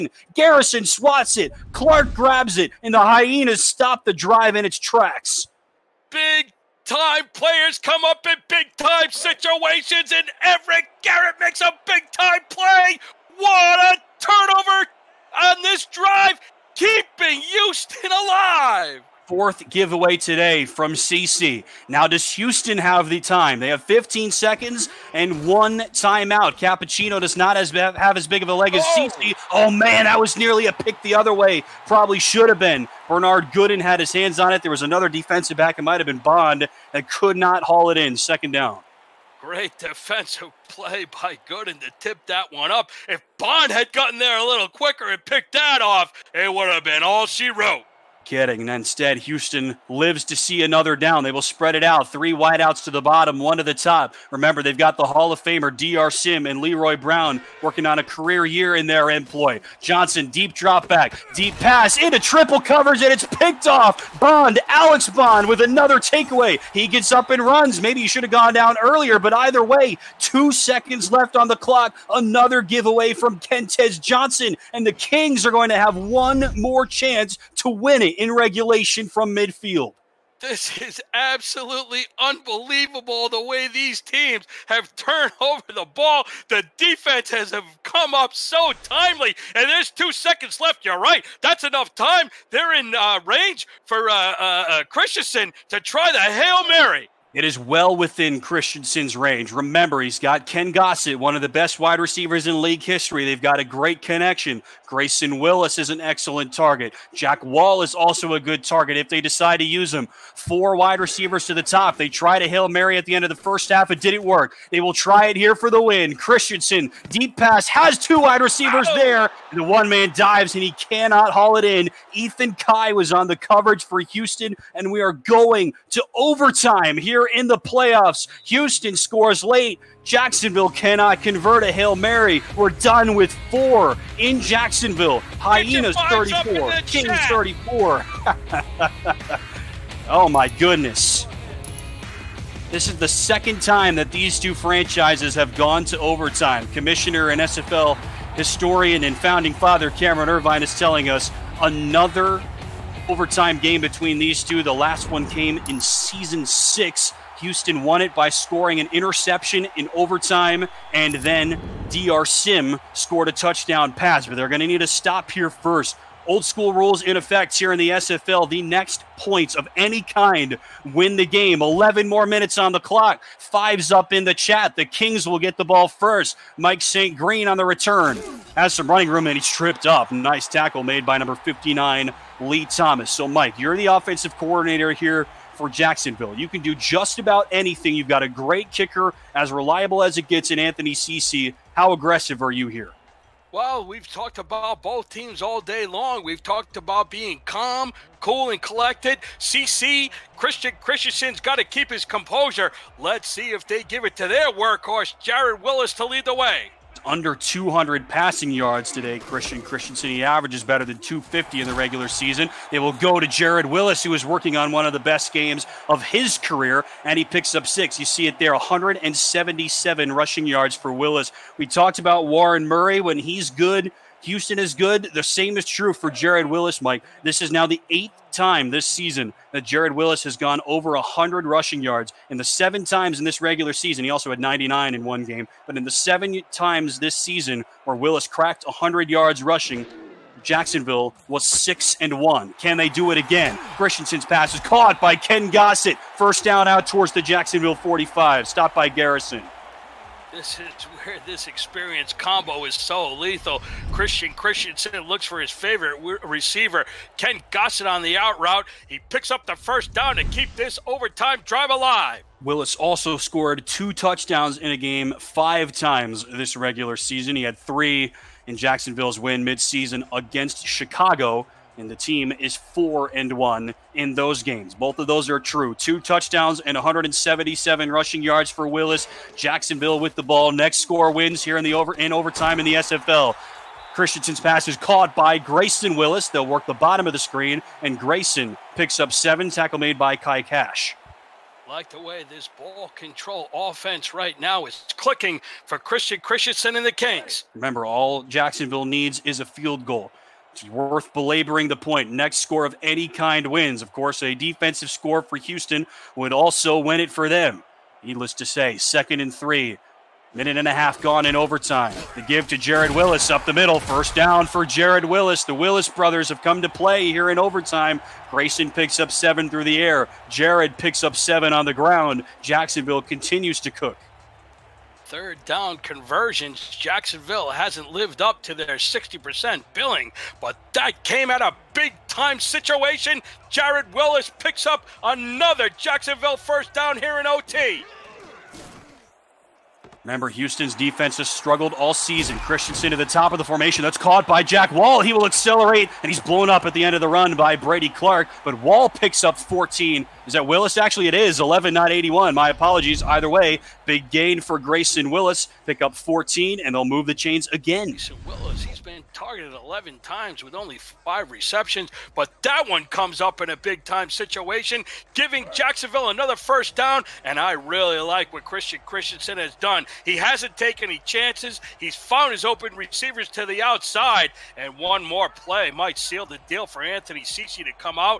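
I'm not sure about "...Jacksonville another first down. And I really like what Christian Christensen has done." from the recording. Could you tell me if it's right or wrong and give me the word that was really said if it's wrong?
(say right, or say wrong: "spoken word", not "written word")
right.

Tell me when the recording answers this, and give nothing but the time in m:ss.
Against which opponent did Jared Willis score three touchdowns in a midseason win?
4:30.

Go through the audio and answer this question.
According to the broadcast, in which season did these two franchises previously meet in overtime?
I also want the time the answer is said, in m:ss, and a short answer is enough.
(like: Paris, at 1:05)
season 6, at 2:35.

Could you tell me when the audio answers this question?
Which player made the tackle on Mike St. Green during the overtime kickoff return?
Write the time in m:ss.
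3:02.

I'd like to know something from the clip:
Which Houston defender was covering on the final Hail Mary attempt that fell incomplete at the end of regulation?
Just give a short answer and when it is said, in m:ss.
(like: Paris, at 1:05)
Ethan Kai, at 2:02.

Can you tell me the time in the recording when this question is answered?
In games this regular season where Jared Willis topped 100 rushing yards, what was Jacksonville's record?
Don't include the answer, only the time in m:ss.
4:01.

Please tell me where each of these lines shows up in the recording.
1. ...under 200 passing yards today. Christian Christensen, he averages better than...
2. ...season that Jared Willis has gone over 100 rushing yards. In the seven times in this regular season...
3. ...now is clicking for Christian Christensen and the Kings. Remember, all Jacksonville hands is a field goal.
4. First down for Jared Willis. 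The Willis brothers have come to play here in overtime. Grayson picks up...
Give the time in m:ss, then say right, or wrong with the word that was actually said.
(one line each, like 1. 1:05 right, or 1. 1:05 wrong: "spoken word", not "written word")
1. 3:27 right
2. 3:48 right
3. 4:54 wrong: "needs", not "hands"
4. 5:13 right.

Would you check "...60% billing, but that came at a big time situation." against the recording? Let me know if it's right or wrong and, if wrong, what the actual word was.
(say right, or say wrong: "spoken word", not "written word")
right.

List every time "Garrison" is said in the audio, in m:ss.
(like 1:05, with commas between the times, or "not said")
0:00, 0:11, 4:08.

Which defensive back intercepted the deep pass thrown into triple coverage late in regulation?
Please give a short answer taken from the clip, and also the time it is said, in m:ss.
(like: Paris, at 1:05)
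Alex Bond, at 1:04.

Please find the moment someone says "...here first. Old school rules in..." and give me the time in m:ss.
2:45.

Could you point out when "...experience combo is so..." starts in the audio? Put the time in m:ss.
4:11.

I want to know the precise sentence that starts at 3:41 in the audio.
We talked about Warren Murray when he's good.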